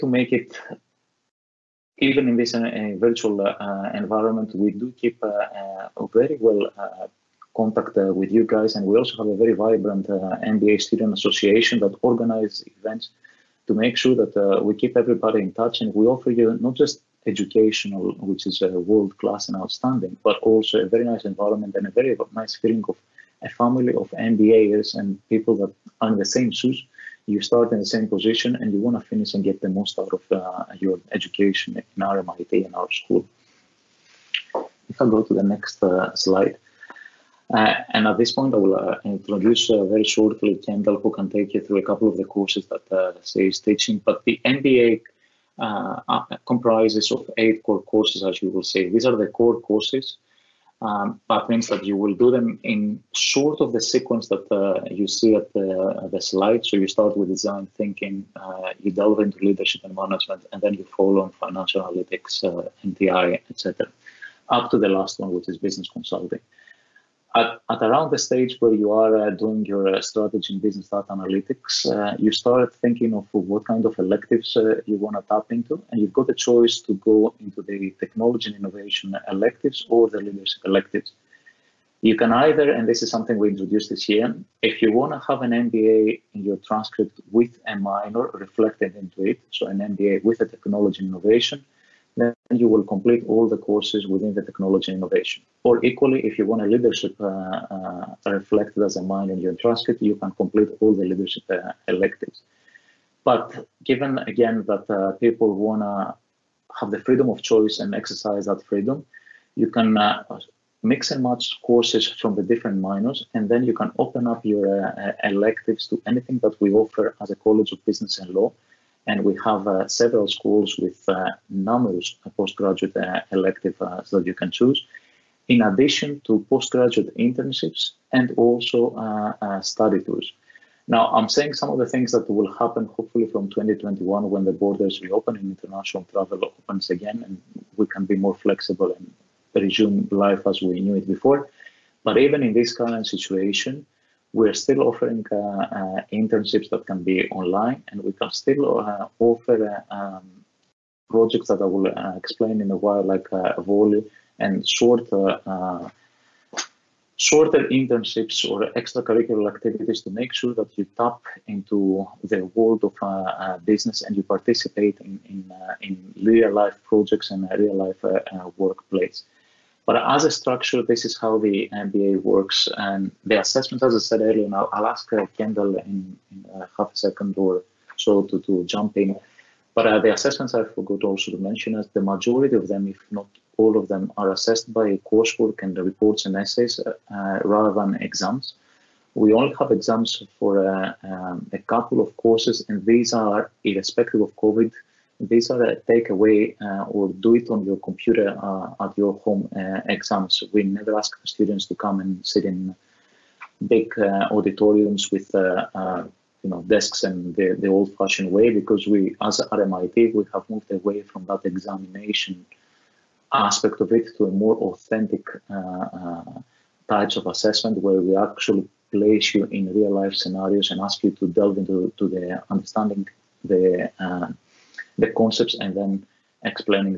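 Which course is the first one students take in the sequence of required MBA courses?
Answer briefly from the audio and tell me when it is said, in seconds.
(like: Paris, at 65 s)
Design thinking, at 57 s.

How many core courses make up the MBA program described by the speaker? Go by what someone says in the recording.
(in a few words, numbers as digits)
8.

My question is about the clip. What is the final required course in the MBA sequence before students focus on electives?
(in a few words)
Business consulting.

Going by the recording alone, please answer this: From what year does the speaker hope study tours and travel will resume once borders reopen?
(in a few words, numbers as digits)
2021.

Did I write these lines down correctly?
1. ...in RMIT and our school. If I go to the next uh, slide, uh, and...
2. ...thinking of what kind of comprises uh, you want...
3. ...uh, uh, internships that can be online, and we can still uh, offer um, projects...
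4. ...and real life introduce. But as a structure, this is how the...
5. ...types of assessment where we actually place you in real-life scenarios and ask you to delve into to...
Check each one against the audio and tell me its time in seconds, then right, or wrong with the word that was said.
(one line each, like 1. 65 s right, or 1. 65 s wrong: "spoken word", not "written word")
1. 31 s right
2. 72 s wrong: "electives", not "comprises"
3. 145 s right
4. 167 s wrong: "workplace", not "introduce"
5. 216 s right.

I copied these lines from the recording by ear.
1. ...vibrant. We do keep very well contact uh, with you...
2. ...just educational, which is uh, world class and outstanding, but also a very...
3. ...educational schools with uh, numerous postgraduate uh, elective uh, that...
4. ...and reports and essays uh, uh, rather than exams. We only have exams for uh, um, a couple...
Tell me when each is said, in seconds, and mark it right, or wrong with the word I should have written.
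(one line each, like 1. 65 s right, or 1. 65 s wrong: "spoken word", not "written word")
1. 4 s wrong: "environment", not "vibrant"
2. 16 s right
3. 119 s wrong: "several", not "educational"
4. 185 s right.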